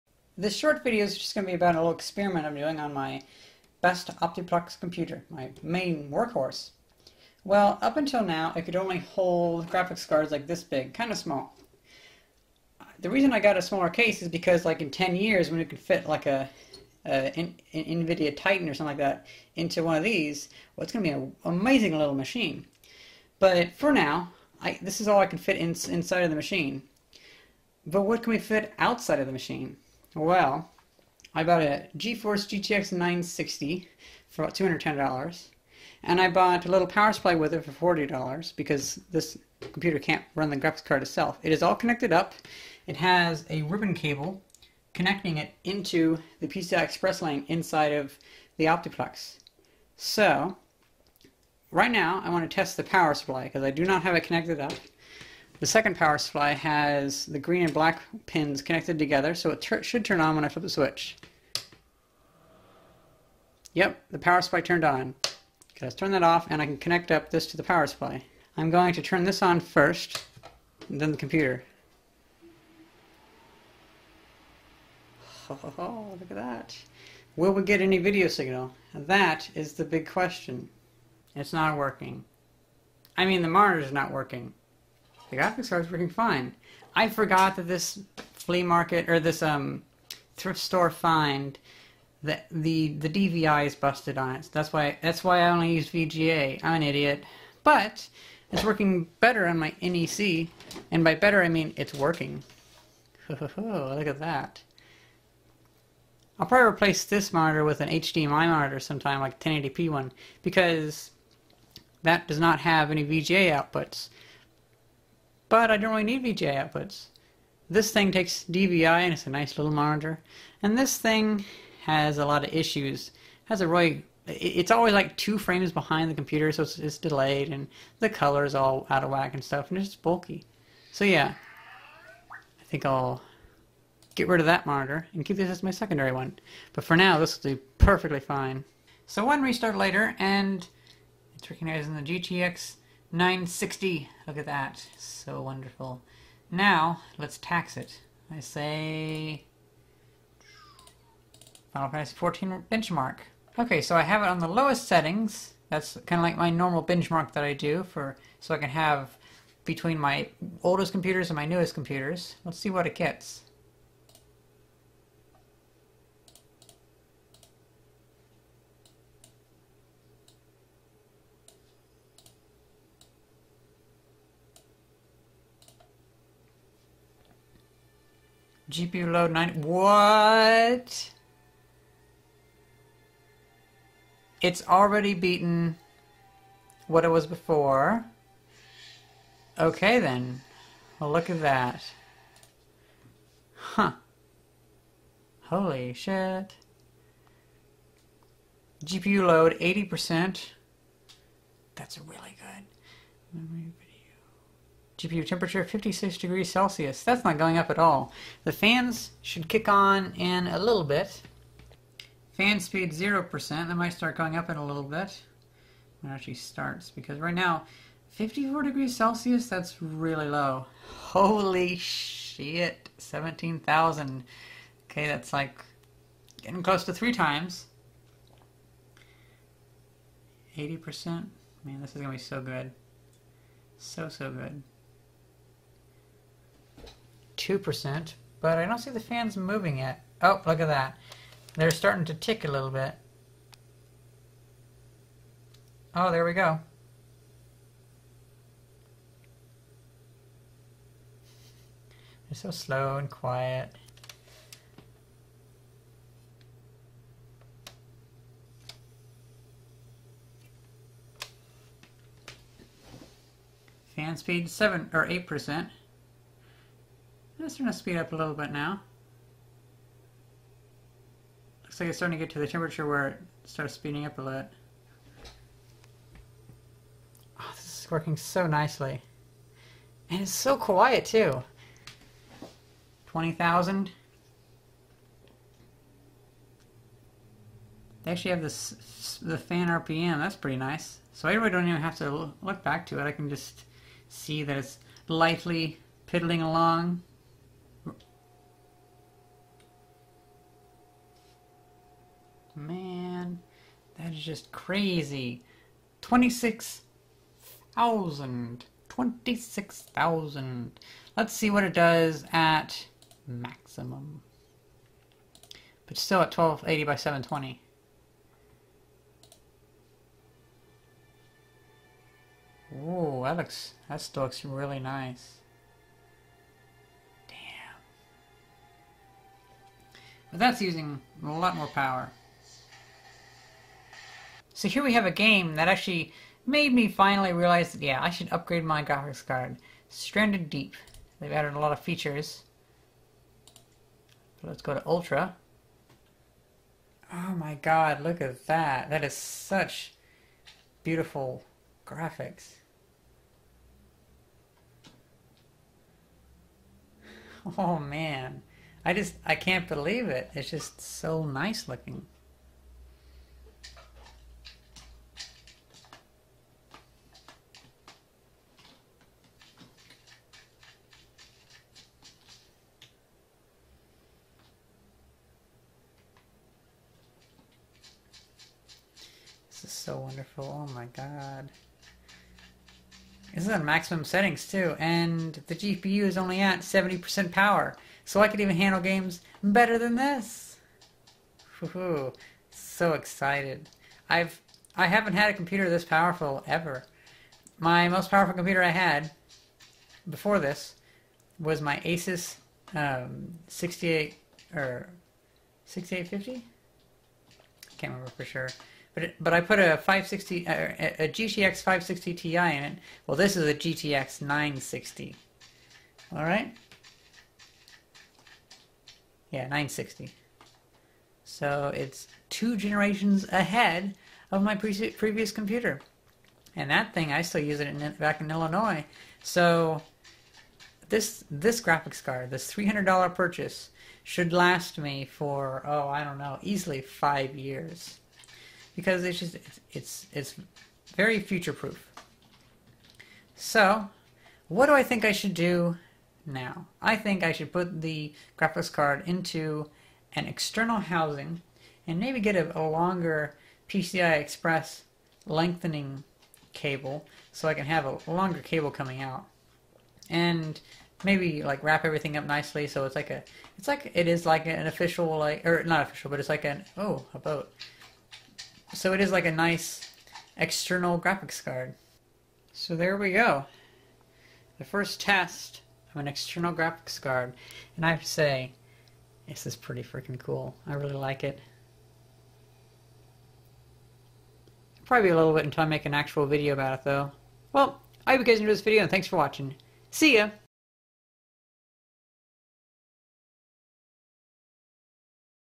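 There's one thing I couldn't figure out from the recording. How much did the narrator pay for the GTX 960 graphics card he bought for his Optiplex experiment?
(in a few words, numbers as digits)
$210.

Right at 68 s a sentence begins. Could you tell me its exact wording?
I'm going to turn this on first, and then the computer.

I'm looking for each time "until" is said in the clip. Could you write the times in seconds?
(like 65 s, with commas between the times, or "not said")
7 s, 485 s.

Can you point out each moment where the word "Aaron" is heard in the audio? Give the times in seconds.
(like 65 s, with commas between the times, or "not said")
not said.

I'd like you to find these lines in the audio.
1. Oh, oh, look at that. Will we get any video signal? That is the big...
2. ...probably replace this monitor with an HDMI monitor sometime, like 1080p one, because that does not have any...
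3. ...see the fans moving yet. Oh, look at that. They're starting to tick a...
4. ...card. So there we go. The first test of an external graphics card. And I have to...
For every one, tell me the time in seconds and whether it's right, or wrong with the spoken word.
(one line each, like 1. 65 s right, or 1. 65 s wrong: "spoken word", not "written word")
1. 75 s right
2. 106 s right
3. 238 s right
4. 471 s right.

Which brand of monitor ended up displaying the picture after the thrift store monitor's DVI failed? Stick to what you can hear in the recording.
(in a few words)
NEC.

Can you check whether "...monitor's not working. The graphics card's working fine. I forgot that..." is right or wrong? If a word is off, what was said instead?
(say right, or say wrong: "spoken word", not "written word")
right.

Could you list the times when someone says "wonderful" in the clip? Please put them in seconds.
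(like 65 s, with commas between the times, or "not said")
145 s, 379 s.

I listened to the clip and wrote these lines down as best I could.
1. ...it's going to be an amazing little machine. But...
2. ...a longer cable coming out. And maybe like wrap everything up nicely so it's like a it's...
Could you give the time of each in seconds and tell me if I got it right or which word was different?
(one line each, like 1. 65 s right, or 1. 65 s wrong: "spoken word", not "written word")
1. 20 s right
2. 457 s right.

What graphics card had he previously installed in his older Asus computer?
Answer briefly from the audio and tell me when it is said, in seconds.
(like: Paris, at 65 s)
GTX 560 Ti, at 411 s.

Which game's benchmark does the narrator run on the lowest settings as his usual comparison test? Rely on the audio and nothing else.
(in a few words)
Final Fantasy 14.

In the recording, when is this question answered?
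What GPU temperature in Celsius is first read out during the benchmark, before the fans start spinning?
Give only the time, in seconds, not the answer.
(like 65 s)
205 s.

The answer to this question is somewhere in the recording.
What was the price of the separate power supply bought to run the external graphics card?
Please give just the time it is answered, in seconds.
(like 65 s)
37 s.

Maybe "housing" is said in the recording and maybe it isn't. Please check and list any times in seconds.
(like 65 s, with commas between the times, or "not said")
450 s.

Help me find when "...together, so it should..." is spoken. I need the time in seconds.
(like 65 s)
58 s.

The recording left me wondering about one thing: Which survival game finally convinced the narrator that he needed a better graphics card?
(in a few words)
Stranded Deep.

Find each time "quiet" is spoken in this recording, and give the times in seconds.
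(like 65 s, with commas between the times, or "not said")
253 s, 280 s.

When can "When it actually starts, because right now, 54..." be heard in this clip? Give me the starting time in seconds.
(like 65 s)
216 s.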